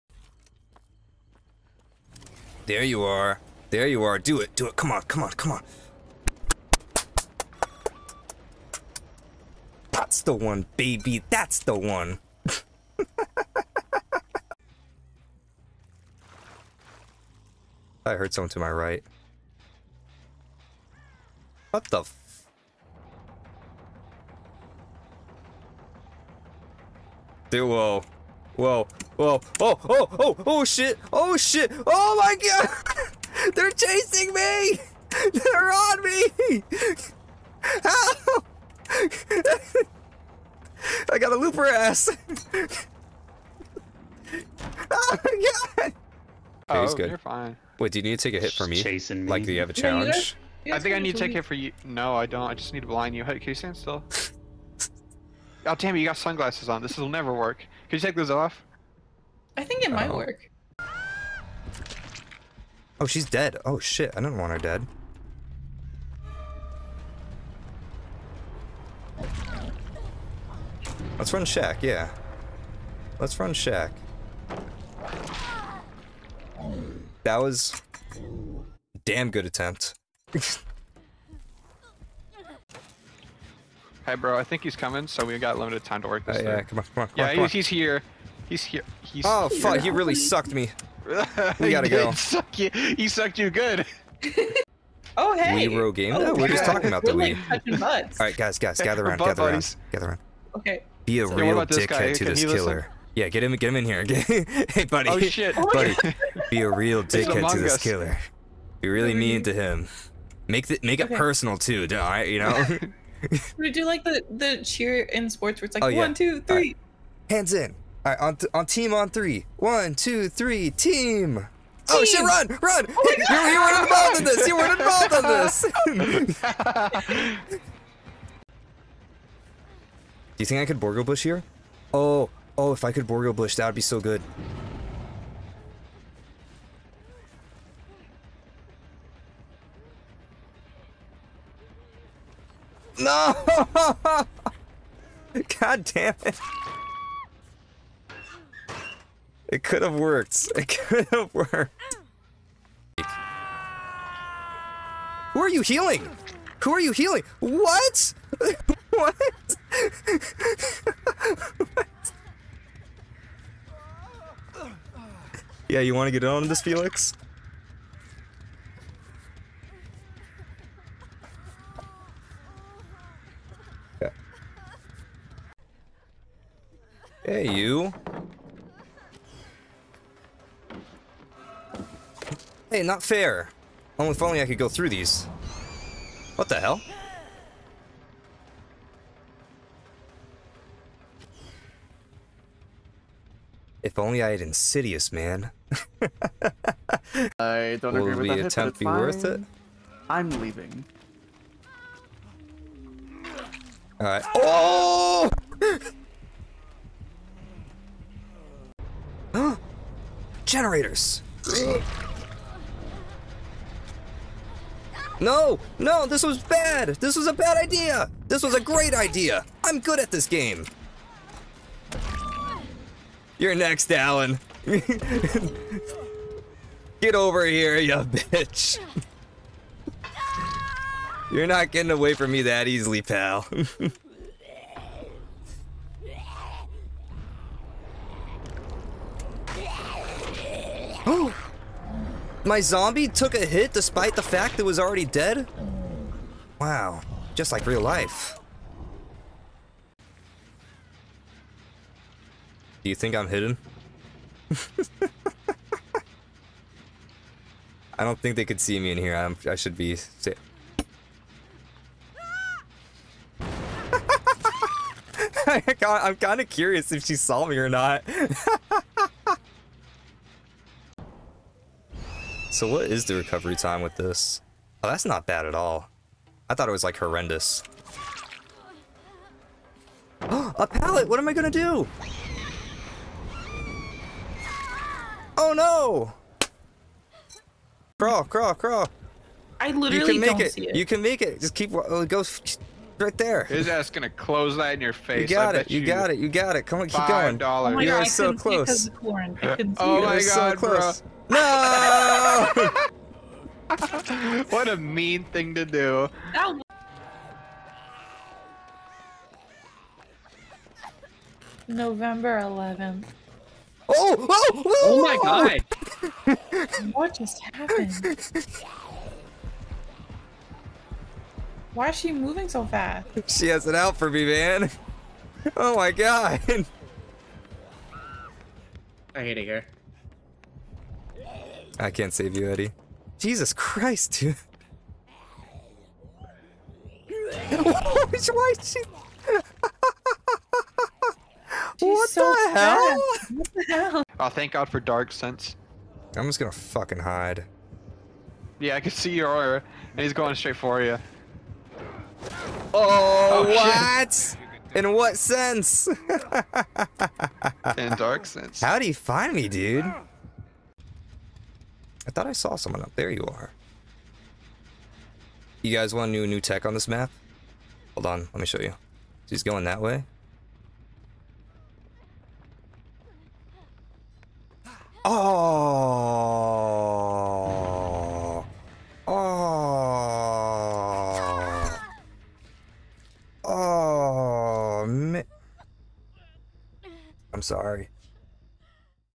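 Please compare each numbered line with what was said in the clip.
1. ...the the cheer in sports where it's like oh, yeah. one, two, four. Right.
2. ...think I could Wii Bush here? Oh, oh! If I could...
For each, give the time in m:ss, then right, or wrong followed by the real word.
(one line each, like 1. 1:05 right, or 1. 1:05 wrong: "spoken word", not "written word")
1. 1:54 wrong: "three", not "four"
2. 2:10 wrong: "Borgo", not "Wii".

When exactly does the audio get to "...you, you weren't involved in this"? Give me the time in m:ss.
2:04.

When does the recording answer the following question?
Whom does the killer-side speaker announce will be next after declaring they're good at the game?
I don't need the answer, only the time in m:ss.
3:43.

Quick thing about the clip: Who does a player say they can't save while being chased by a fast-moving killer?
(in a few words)
Eddie.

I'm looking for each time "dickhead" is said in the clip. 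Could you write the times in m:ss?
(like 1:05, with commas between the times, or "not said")
1:41, 1:47.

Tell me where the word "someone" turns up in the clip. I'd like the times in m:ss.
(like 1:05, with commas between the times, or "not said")
0:18, 6:02.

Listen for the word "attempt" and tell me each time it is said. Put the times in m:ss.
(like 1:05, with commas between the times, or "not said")
1:19, 3:18.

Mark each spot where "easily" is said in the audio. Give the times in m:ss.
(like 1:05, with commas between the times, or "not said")
3:52.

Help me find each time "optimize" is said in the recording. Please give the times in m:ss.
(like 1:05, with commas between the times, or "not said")
not said.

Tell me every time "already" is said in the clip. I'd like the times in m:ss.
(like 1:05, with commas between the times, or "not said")
4:04.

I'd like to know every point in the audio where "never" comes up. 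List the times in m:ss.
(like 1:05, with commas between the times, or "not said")
0:57.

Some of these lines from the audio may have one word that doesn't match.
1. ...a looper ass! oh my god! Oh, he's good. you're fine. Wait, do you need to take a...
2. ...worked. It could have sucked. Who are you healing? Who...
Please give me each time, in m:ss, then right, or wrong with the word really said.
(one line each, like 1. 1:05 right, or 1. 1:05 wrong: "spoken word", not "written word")
1. 0:41 right
2. 2:29 wrong: "worked", not "sucked".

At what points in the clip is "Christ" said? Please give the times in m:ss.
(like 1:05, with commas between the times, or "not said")
5:33.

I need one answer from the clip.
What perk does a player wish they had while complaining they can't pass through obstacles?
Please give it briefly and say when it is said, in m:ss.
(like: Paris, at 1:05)
Insidious, at 3:14.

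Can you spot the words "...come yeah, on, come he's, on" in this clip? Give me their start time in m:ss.
1:27.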